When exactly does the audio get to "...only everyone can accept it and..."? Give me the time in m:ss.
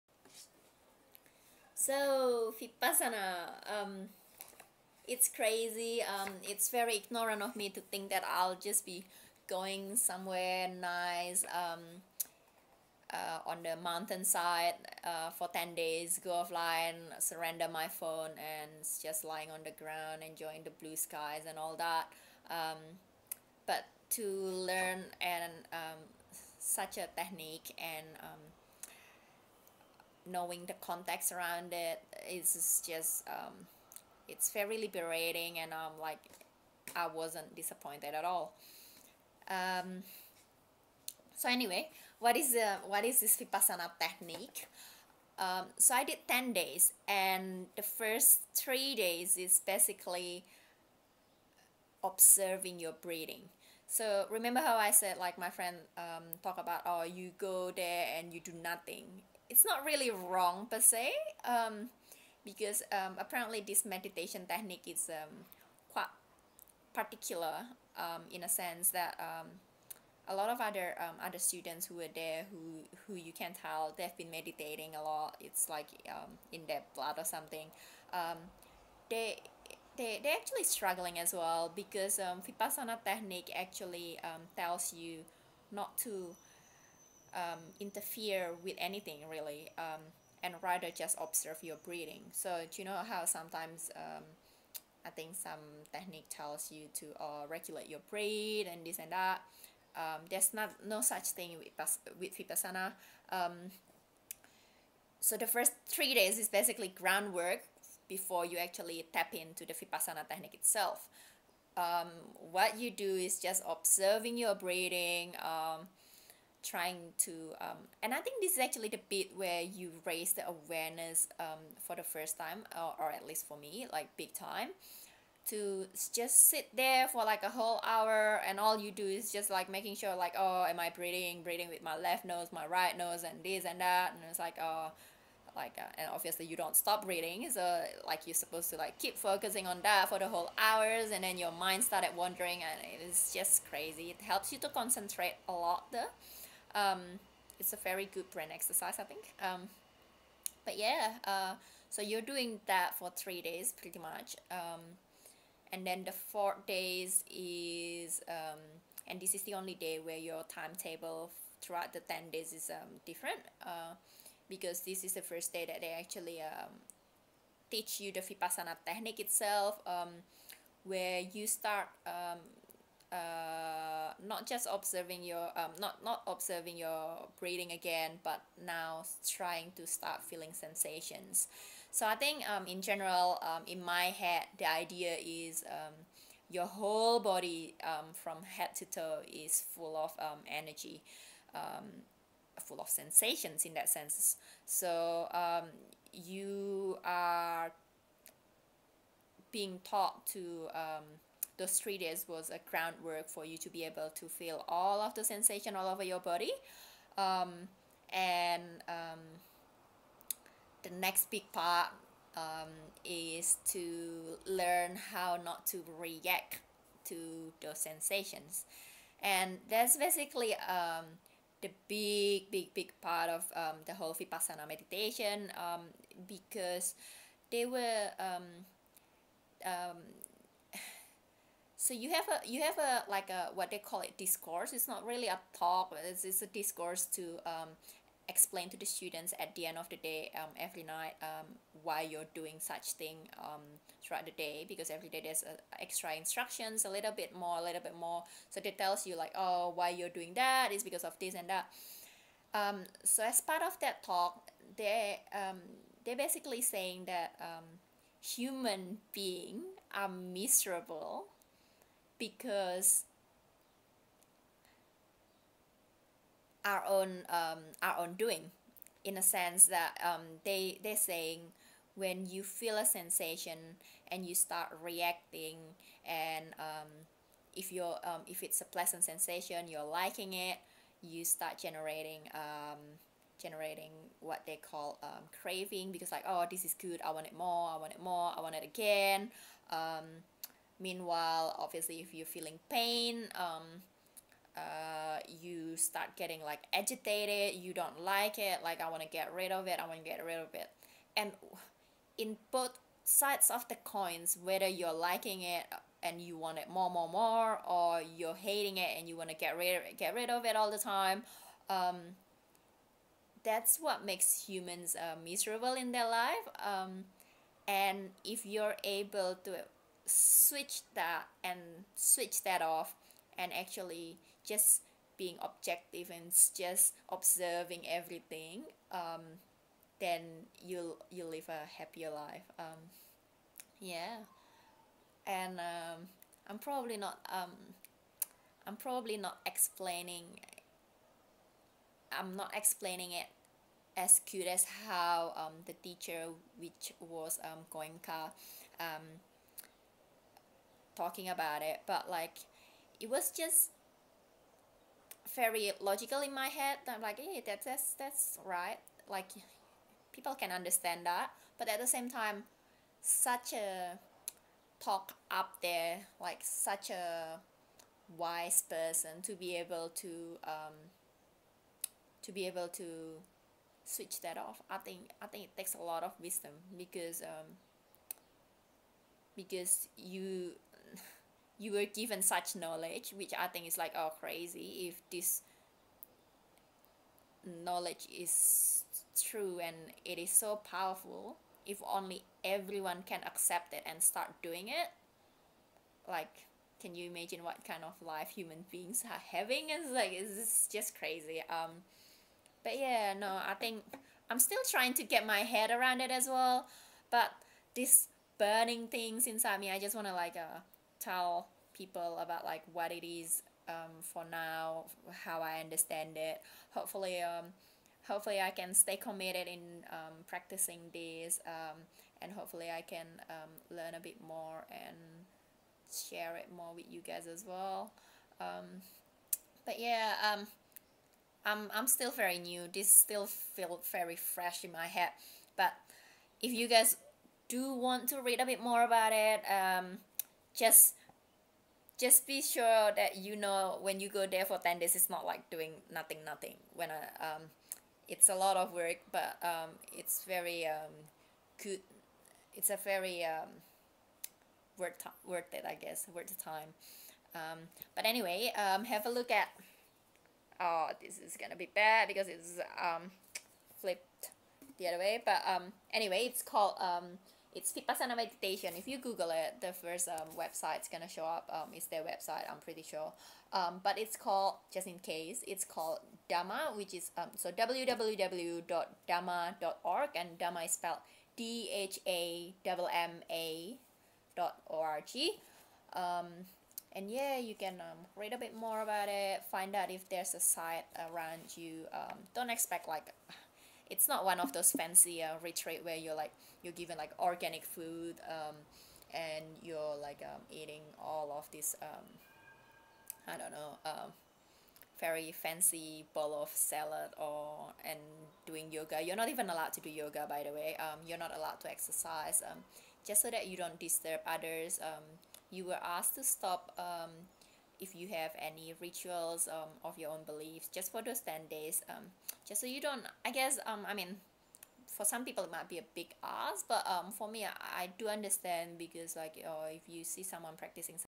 6:31.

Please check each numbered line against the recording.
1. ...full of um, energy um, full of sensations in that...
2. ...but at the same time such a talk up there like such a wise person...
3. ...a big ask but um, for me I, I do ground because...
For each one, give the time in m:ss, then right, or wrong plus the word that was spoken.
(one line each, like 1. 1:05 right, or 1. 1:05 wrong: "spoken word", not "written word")
1. 3:09 right
2. 6:01 right
3. 8:45 wrong: "understand", not "ground".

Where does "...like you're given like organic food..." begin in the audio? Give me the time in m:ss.
8:16.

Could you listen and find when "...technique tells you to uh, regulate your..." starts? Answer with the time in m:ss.
1:35.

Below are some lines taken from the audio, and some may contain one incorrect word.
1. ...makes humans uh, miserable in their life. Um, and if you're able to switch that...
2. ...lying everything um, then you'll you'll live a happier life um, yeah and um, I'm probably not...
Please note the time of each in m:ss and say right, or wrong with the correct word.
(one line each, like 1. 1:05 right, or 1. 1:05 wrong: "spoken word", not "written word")
1. 5:14 right
2. 5:27 wrong: "observing", not "lying".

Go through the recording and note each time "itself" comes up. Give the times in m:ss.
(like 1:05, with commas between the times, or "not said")
1:50, 2:49.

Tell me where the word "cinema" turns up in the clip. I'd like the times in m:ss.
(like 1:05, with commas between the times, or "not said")
not said.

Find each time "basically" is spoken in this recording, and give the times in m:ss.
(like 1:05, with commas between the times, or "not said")
0:49, 1:46, 3:39, 4:16.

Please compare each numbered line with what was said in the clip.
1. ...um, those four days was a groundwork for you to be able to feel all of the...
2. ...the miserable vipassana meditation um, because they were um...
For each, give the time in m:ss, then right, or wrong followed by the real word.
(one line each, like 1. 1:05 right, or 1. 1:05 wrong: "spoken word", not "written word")
1. 3:20 wrong: "three", not "four"
2. 3:43 wrong: "whole", not "miserable".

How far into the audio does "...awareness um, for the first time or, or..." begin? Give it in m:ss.
2:00.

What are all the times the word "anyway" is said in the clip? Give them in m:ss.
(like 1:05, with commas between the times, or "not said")
0:41, 7:38, 7:45.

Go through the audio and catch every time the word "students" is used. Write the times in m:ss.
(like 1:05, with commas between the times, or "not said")
1:11, 3:58.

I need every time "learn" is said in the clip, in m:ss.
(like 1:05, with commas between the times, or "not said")
0:24, 3:34, 7:03.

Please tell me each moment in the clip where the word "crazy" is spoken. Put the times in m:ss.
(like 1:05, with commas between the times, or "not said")
0:05, 2:23, 6:24, 6:40.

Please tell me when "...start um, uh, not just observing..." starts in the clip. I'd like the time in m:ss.
2:51.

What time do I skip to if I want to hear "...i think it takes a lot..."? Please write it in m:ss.
6:15.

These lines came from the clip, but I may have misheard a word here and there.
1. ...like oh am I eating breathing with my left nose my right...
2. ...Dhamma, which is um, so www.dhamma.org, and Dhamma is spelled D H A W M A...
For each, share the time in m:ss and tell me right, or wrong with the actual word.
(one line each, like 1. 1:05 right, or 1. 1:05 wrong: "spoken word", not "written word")
1. 2:10 wrong: "breathing", not "eating"
2. 7:56 right.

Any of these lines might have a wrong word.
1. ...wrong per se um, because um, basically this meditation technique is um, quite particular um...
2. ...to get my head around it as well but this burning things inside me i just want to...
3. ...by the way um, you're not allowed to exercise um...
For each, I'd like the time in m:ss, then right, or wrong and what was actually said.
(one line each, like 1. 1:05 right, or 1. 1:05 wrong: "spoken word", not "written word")
1. 1:00 wrong: "apparently", not "basically"
2. 6:44 right
3. 8:30 right.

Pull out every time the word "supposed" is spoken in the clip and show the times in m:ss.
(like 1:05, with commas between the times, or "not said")
2:18.